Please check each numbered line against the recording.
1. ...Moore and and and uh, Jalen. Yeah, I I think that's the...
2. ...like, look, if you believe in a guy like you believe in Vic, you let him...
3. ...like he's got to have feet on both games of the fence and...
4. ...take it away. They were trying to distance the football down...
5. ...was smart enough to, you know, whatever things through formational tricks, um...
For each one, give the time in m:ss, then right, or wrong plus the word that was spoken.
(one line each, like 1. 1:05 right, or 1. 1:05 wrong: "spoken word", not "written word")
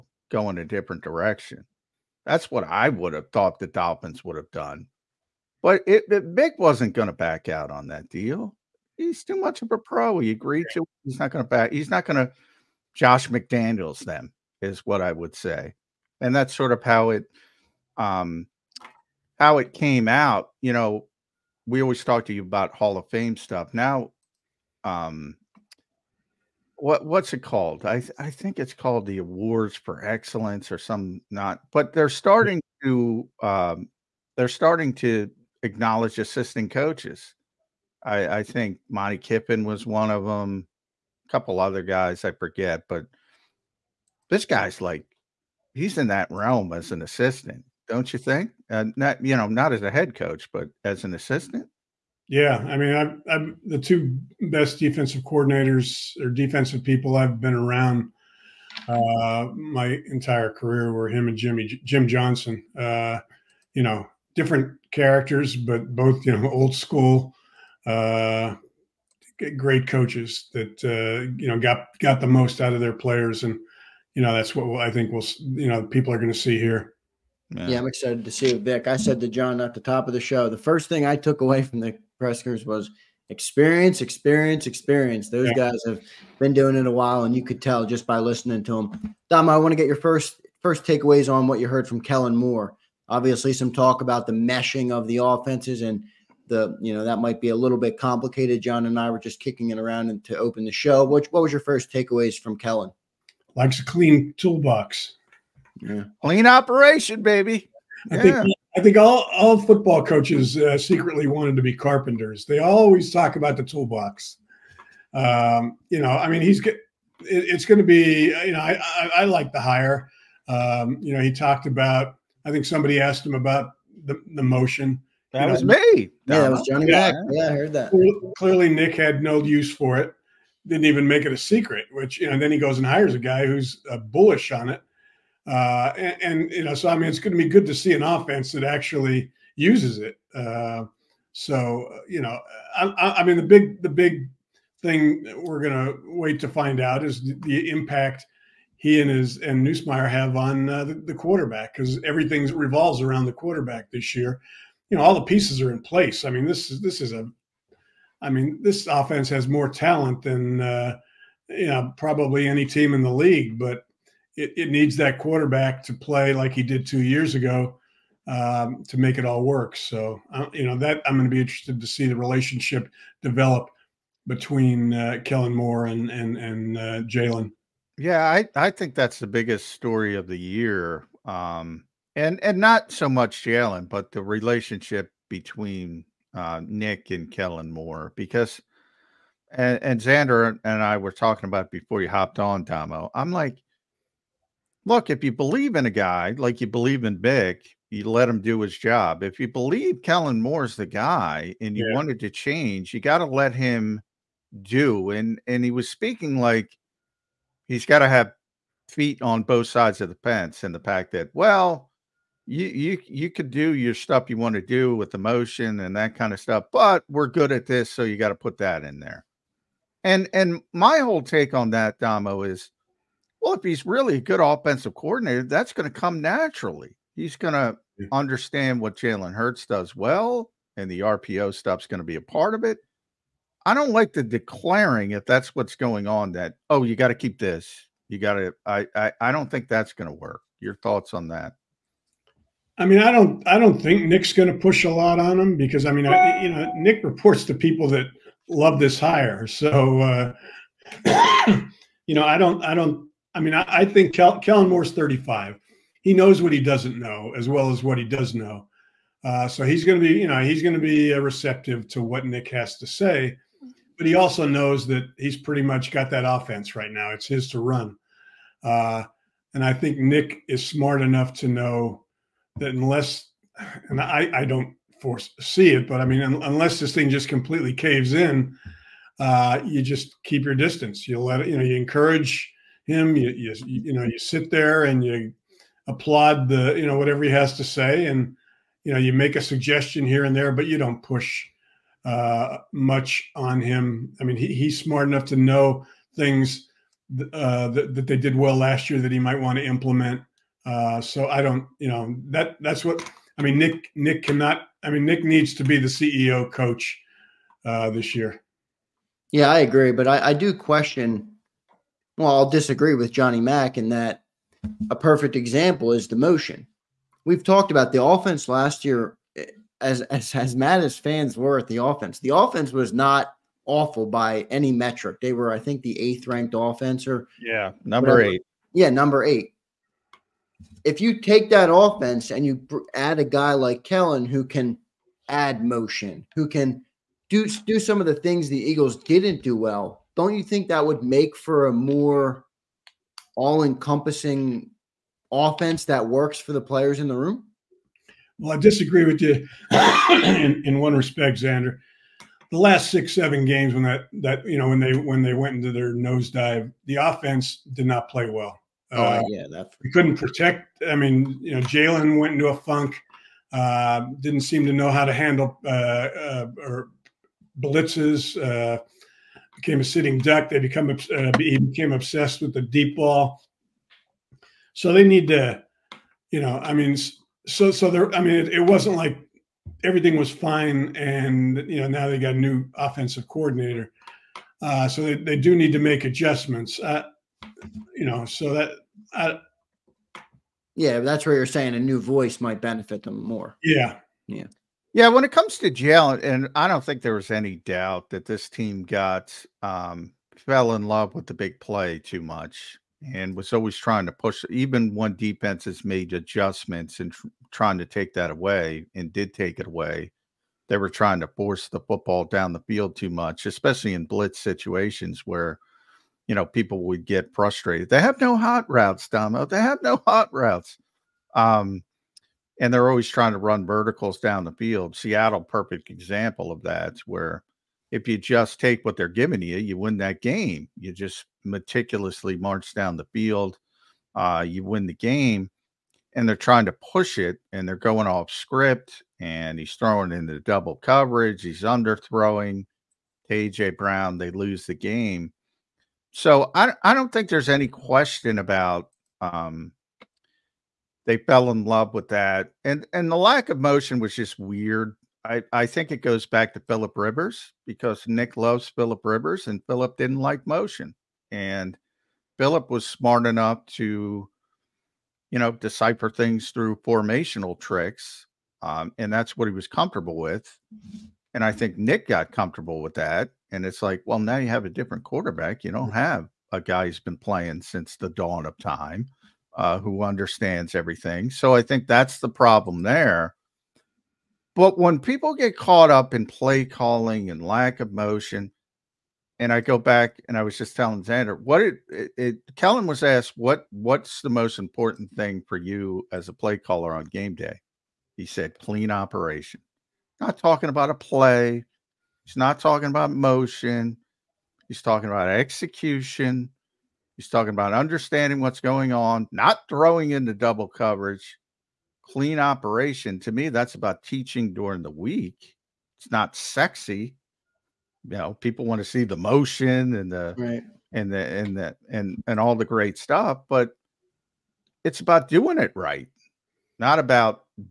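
1. 2:55 right
2. 3:13 right
3. 3:26 wrong: "sides", not "games"
4. 6:49 wrong: "force", not "distance"
5. 7:42 wrong: "decipher", not "whatever".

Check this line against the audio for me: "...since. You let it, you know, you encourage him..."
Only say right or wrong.
wrong.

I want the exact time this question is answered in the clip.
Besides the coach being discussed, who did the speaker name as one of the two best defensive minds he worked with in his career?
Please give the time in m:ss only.
1:01.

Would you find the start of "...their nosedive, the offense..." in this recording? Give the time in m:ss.
5:55.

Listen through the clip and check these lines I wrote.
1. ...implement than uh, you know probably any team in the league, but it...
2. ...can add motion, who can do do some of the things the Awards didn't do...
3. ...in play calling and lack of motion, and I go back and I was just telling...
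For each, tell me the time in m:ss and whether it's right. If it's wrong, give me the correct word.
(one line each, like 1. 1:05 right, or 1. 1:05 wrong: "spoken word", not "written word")
1. 2:39 wrong: "talent", not "implement"
2. 5:34 wrong: "Eagles", not "Awards"
3. 8:06 right.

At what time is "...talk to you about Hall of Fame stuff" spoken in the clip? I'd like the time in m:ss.
0:22.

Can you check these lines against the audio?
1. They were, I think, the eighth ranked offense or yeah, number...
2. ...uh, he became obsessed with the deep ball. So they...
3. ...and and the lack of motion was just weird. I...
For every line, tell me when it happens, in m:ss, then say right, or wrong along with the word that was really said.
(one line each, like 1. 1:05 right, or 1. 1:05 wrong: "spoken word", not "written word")
1. 5:25 right
2. 6:10 right
3. 7:32 right.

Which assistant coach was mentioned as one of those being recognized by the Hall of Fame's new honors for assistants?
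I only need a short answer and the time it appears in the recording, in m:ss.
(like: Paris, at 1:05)
Monte Kiffin, at 0:38.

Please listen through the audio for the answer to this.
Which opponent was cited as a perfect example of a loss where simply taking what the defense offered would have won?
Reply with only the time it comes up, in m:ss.
7:04.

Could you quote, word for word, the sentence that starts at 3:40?
And and my whole take on that, Damo, is well, if he's really a good offensive coordinator, that's going to come naturally.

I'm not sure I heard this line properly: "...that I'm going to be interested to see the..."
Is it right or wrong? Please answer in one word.
right.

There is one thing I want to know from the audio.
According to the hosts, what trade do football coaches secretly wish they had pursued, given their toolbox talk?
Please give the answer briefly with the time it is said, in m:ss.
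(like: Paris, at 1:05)
Carpenters, at 1:51.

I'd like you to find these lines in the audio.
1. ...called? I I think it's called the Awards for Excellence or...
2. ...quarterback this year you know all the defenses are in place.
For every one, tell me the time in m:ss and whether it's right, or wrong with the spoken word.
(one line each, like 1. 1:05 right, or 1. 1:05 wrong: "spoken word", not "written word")
1. 0:27 right
2. 2:33 wrong: "pieces", not "defenses".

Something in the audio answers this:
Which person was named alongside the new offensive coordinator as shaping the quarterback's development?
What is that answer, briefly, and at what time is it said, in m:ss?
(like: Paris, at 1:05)
Nussmeier, at 2:29.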